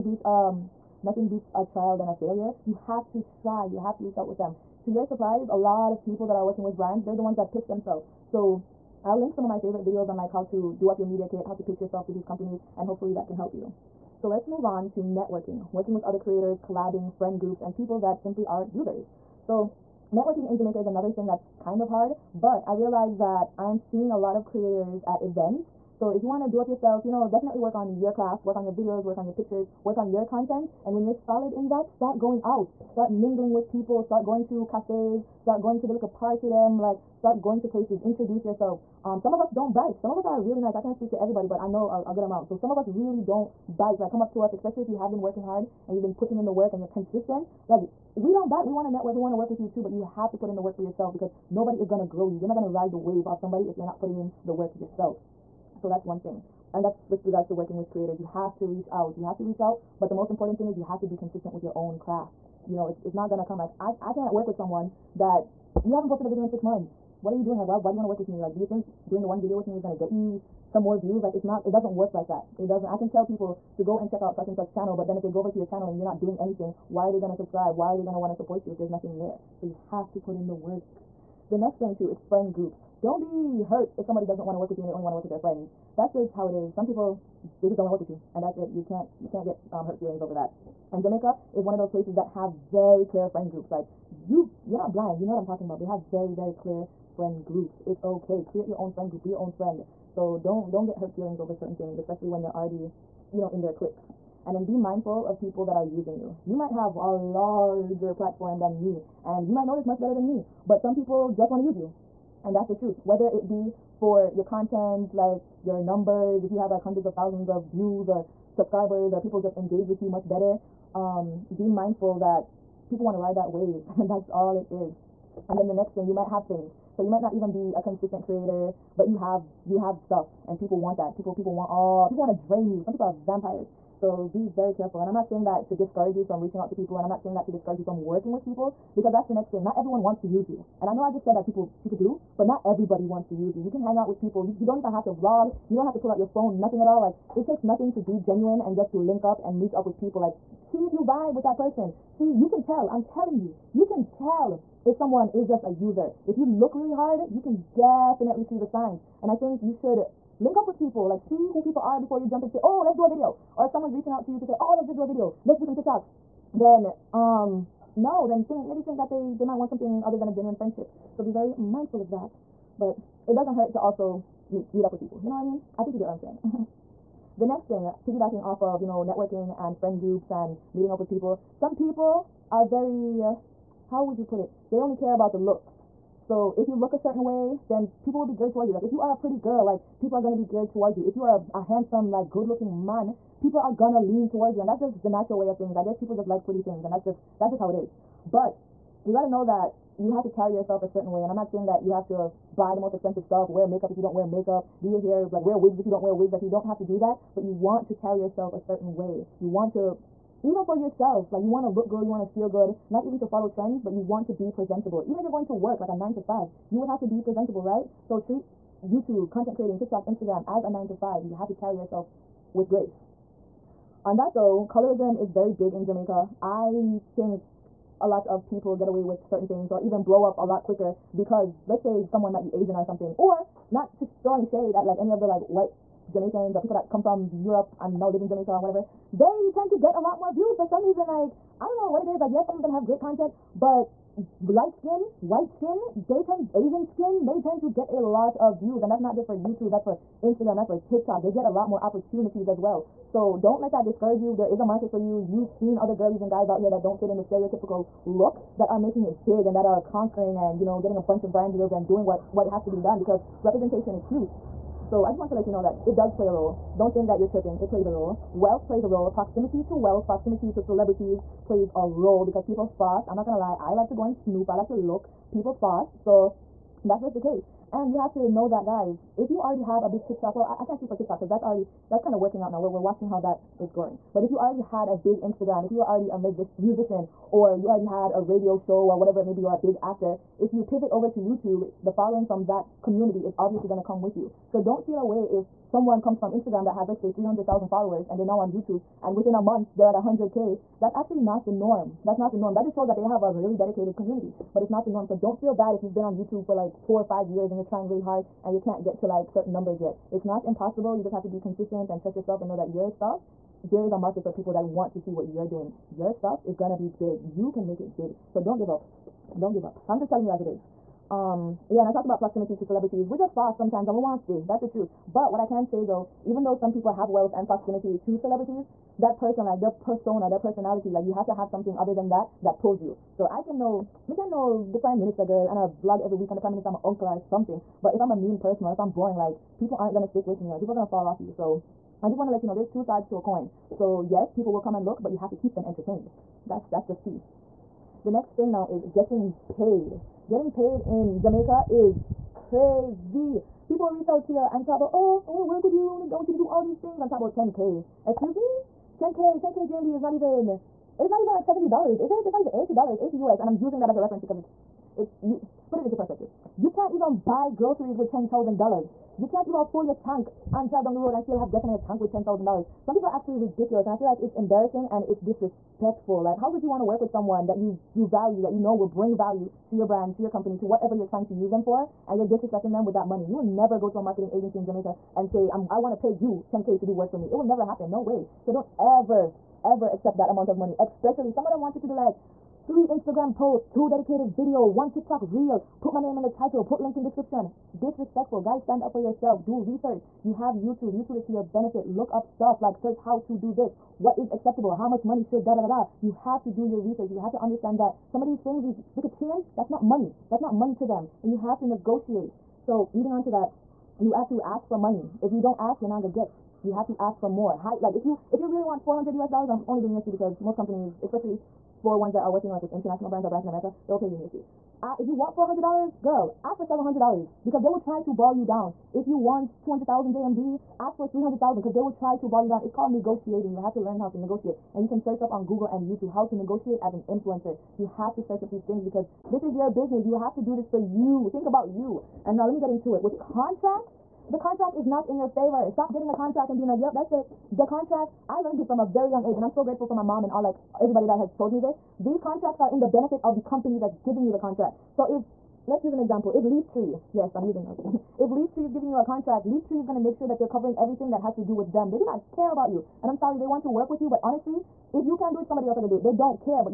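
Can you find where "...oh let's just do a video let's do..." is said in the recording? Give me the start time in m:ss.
2:44.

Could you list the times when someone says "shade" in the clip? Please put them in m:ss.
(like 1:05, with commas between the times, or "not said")
3:54.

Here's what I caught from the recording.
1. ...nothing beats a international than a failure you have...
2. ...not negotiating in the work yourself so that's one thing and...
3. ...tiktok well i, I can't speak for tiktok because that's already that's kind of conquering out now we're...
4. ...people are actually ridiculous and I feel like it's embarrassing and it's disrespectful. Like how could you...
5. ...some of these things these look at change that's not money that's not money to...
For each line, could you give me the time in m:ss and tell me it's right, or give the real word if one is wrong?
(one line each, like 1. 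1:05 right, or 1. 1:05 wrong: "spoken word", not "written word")
1. 0:01 wrong: "trial", not "international"
2. 0:53 wrong: "putting", not "negotiating"
3. 4:40 wrong: "working", not "conquering"
4. 6:12 right
5. 6:48 right.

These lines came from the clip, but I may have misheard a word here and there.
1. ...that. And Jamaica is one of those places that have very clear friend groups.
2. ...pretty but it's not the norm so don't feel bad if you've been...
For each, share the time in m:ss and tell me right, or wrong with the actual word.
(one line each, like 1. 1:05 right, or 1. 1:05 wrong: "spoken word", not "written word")
1. 1:30 right
2. 5:03 wrong: "community", not "pretty".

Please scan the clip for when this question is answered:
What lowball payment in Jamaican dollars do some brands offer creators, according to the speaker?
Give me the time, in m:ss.
5:59.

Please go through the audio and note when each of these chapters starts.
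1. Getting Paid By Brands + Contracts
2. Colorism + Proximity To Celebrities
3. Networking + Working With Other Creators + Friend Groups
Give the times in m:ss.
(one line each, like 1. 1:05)
1. 5:49
2. 3:44
3. 0:15.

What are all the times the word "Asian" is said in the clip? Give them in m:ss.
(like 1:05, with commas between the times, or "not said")
3:52, 4:06.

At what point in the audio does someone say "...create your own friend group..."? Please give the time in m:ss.
1:38.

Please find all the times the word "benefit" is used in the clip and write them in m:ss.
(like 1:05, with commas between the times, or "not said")
6:41, 7:32.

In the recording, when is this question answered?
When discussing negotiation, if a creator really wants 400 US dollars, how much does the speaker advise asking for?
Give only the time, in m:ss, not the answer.
7:06.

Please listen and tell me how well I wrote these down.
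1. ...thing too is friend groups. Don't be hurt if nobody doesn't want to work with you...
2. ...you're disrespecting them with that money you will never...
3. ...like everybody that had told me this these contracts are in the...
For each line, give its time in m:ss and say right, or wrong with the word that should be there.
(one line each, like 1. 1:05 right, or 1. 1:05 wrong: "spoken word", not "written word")
1. 1:21 wrong: "somebody", not "nobody"
2. 6:22 right
3. 7:30 right.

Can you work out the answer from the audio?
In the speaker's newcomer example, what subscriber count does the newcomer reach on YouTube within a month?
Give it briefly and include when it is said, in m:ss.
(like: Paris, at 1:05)
100k, at 4:59.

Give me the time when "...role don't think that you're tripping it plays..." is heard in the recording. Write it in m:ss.
4:26.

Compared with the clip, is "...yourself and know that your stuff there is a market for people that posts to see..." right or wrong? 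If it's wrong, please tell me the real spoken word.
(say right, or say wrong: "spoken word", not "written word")
wrong: "wants", not "posts".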